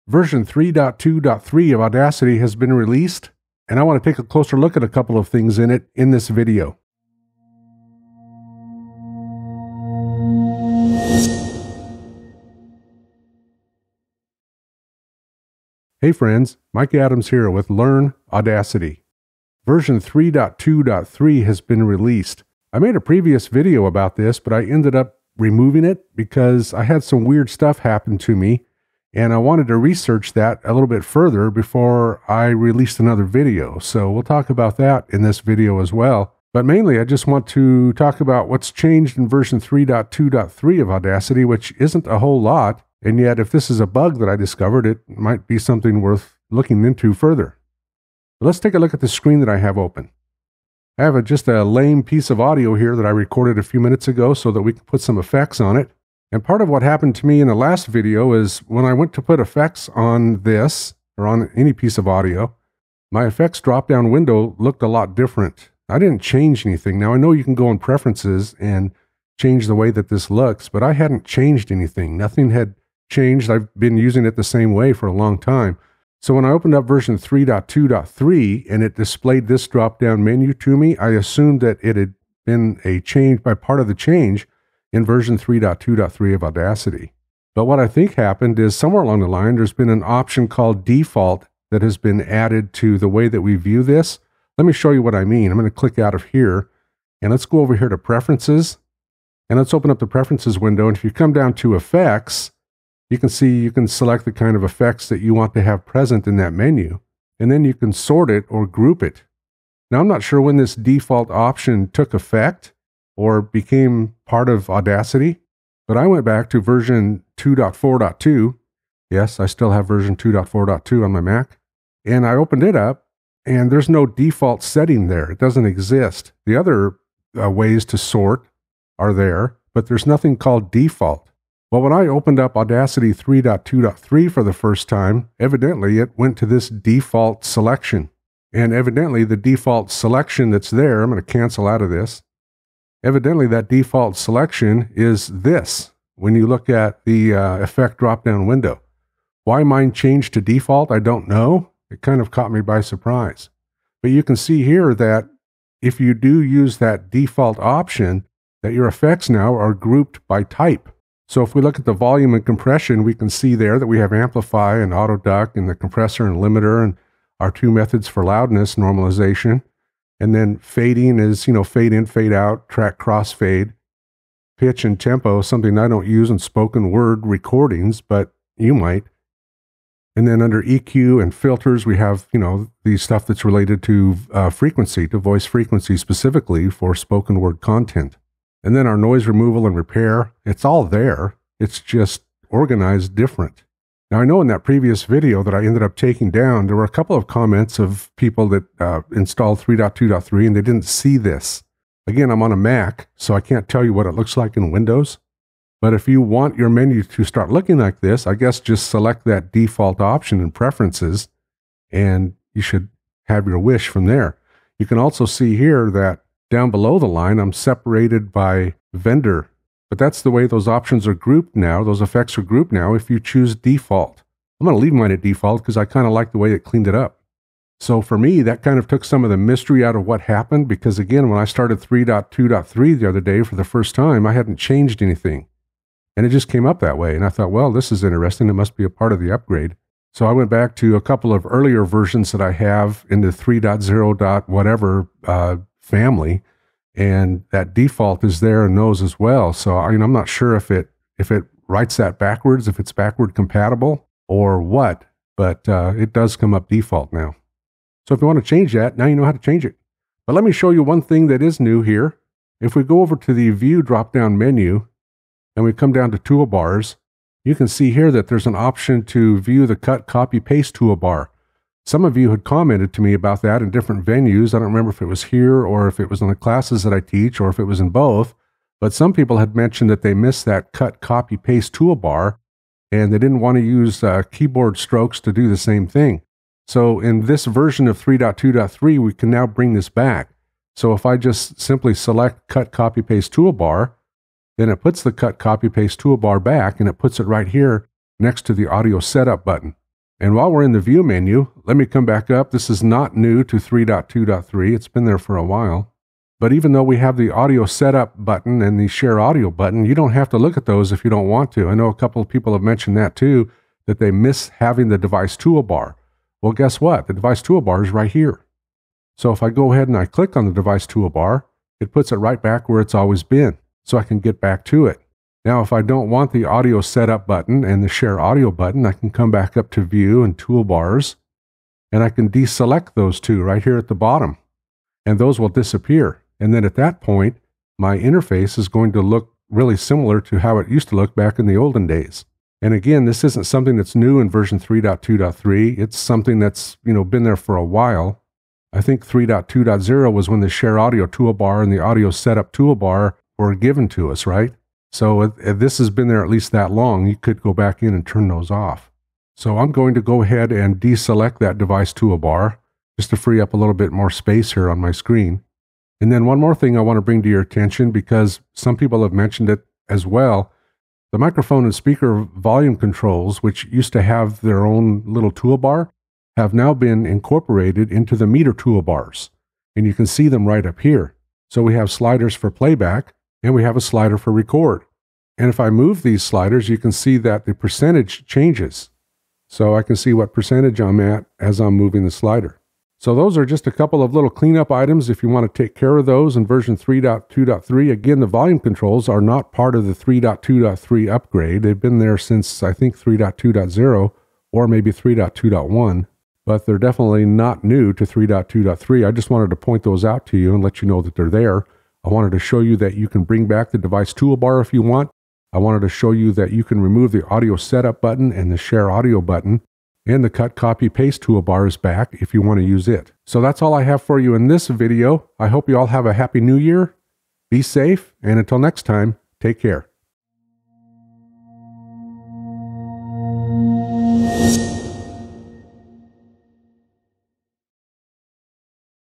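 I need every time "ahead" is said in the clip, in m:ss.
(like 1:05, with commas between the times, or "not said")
5:19, 6:00.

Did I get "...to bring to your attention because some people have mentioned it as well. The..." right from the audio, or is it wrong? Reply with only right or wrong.
right.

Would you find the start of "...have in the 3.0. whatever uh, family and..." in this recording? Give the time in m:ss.
4:02.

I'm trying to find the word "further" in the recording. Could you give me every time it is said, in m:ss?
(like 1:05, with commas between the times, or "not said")
0:31, 0:47.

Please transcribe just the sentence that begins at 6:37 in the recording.
Again, the volume controls are not part of the 3.2.3 upgrade.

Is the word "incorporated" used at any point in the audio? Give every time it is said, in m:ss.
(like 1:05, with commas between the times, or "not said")
6:17.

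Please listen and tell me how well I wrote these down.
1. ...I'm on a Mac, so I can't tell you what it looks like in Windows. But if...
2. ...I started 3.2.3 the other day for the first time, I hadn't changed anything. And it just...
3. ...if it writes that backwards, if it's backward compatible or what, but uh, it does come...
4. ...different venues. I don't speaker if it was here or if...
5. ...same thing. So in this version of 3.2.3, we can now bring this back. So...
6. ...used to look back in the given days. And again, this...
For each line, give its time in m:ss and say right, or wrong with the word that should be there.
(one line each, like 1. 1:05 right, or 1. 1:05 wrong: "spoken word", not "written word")
1. 3:22 right
2. 3:51 right
3. 4:11 right
4. 4:33 wrong: "remember", not "speaker"
5. 4:45 right
6. 5:40 wrong: "olden", not "given".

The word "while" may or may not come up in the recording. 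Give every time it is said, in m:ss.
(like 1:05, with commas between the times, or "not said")
5:00, 5:05, 5:47.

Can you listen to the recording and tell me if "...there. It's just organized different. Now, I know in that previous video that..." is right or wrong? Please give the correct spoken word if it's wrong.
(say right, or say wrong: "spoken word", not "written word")
right.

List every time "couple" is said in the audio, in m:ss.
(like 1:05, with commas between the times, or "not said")
0:04, 3:16, 4:01, 5:11, 6:33.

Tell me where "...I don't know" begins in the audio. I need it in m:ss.
2:30.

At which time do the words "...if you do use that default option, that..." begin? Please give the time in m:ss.
2:35.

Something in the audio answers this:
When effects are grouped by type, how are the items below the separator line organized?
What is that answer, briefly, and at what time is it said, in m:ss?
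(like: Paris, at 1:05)
by vendor, at 3:38.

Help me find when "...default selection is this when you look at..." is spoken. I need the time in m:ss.
2:23.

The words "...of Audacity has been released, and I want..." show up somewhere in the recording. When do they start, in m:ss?
0:01.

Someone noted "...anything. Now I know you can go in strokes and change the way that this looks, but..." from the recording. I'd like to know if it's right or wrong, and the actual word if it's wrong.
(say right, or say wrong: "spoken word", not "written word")
wrong: "preferences", not "strokes".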